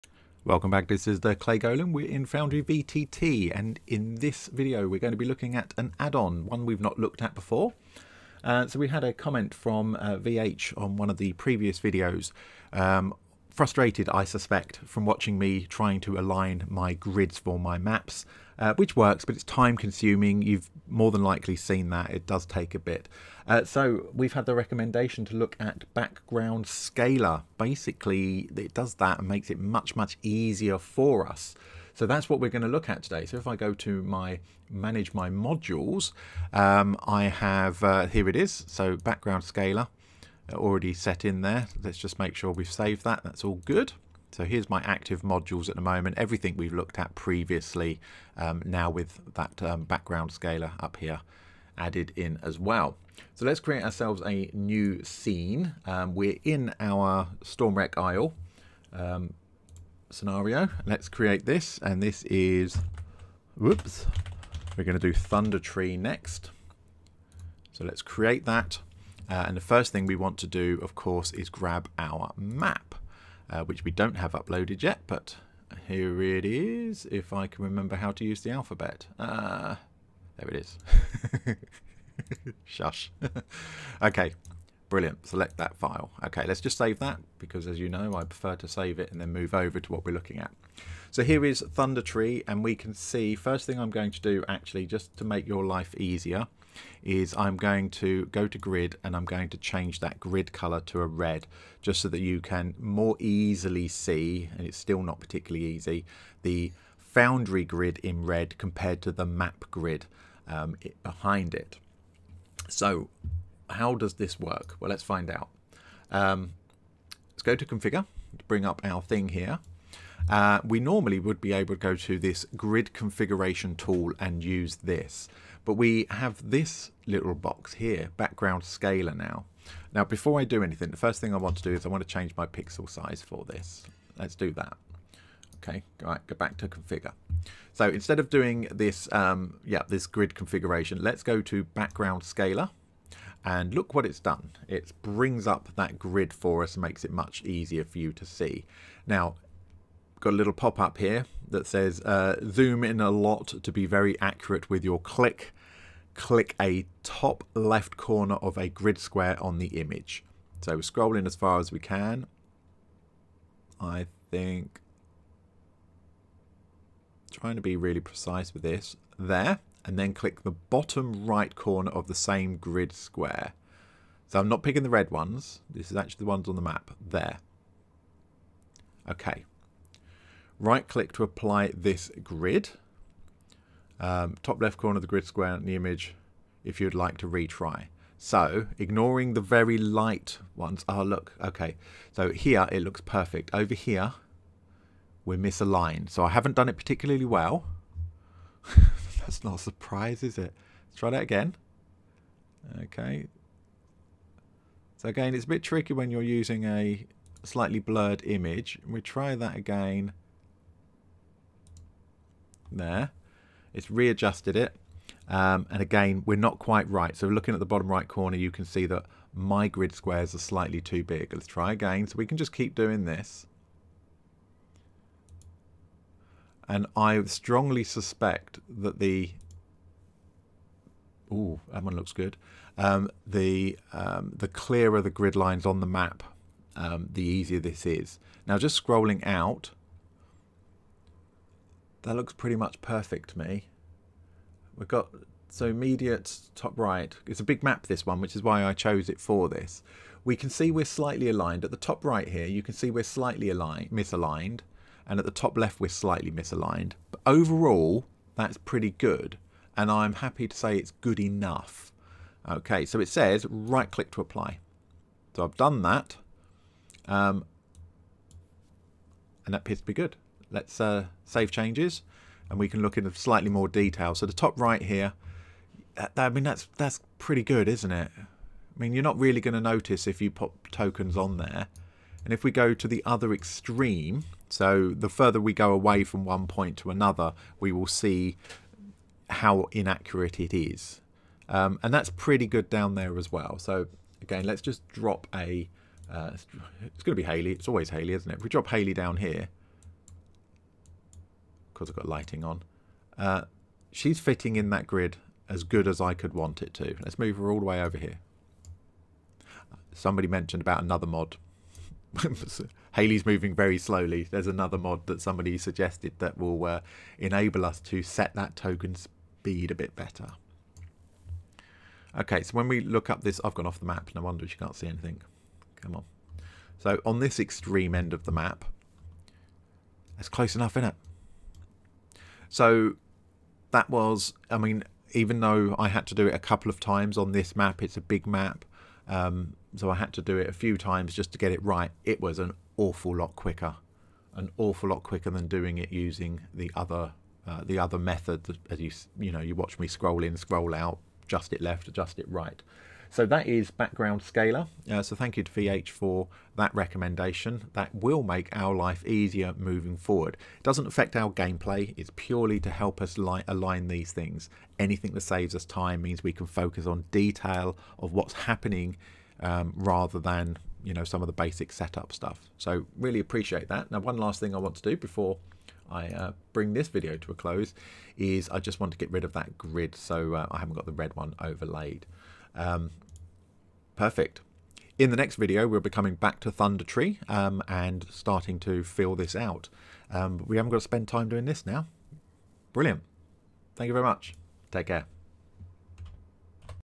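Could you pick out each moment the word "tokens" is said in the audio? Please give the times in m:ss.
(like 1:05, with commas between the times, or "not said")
4:40, 5:18.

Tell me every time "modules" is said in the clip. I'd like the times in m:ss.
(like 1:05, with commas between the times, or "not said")
0:35, 0:45.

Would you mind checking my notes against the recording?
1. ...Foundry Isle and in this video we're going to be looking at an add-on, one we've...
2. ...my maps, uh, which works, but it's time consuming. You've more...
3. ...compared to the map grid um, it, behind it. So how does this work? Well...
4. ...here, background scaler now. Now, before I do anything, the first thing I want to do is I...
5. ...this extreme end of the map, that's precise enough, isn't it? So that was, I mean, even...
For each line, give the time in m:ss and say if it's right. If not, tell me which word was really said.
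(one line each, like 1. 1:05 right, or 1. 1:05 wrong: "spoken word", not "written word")
1. 0:02 wrong: "VTT", not "Isle"
2. 0:17 right
3. 1:48 right
4. 2:07 right
5. 5:27 wrong: "close", not "precise".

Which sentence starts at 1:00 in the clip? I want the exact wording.
Let's create this, and this is, whoops, we're gonna do Thunder Tree next.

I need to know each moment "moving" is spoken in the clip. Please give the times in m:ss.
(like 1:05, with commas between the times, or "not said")
5:13, 5:59.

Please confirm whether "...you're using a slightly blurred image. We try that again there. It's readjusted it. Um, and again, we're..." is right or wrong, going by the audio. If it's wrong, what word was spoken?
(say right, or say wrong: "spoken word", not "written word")
right.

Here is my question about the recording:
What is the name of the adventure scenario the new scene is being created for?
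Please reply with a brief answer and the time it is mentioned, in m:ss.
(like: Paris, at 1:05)
Stormwreck Isle, at 0:57.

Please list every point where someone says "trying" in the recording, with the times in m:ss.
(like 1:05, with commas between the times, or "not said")
0:15, 2:47.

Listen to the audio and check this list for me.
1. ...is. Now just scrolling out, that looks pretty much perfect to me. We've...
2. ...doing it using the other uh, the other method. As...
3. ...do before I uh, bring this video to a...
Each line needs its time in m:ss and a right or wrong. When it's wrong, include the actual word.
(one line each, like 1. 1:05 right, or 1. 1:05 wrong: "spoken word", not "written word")
1. 3:57 right
2. 5:45 right
3. 6:14 right.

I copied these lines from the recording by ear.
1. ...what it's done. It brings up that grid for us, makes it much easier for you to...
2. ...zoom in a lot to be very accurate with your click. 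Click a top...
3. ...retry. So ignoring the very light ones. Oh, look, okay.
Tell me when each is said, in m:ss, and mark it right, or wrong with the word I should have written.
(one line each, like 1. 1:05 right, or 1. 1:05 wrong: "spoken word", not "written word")
1. 2:23 right
2. 2:32 right
3. 3:07 right.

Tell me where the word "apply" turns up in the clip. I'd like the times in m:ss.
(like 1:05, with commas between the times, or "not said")
3:01, 4:24.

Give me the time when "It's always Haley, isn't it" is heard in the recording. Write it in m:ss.
4:57.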